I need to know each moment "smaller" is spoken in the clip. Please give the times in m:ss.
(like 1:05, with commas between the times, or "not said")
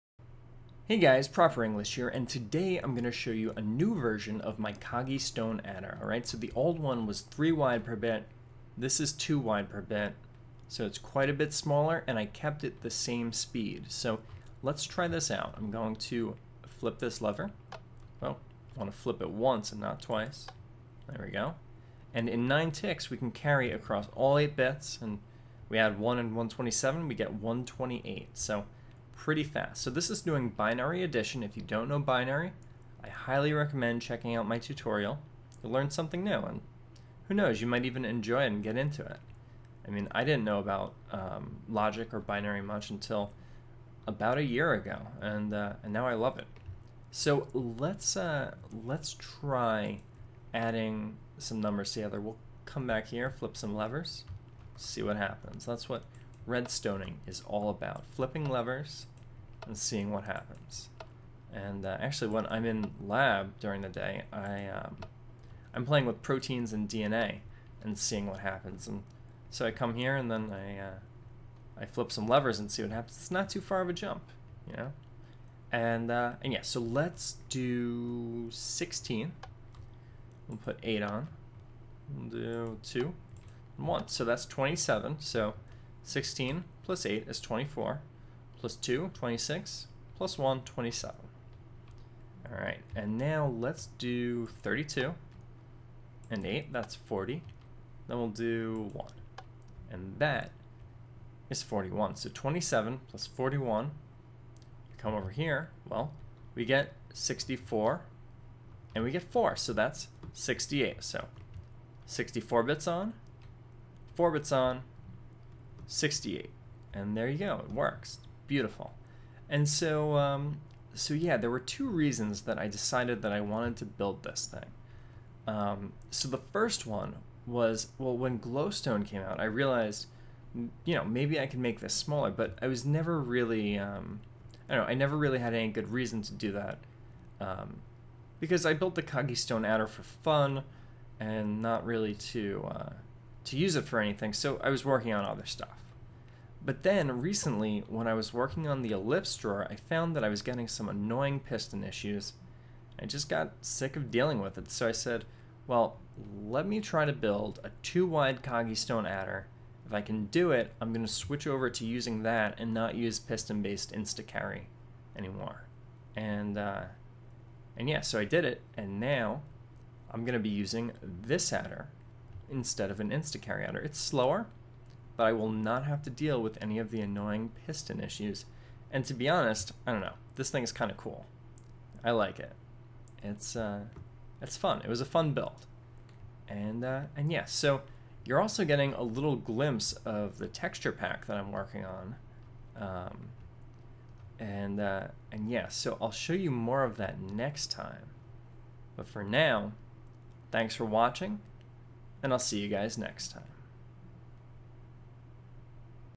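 0:11, 2:11.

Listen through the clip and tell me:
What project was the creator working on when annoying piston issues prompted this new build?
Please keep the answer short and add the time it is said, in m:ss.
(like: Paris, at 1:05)
The ellipse drawer, at 2:28.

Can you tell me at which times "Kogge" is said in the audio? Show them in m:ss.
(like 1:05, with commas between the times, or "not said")
0:04, 2:19, 2:38.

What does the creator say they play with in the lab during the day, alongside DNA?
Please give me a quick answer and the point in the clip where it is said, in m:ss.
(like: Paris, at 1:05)
Proteins, at 1:06.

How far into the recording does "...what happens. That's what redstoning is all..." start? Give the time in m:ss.
0:55.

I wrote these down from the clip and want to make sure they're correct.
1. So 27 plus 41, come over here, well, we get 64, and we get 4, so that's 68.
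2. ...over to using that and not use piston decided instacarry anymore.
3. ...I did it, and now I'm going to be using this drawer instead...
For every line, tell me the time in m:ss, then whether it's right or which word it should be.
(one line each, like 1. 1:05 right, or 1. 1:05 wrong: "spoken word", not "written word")
1. 1:42 right
2. 2:41 wrong: "based", not "decided"
3. 2:48 wrong: "adder", not "drawer".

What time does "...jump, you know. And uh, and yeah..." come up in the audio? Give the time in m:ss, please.
1:13.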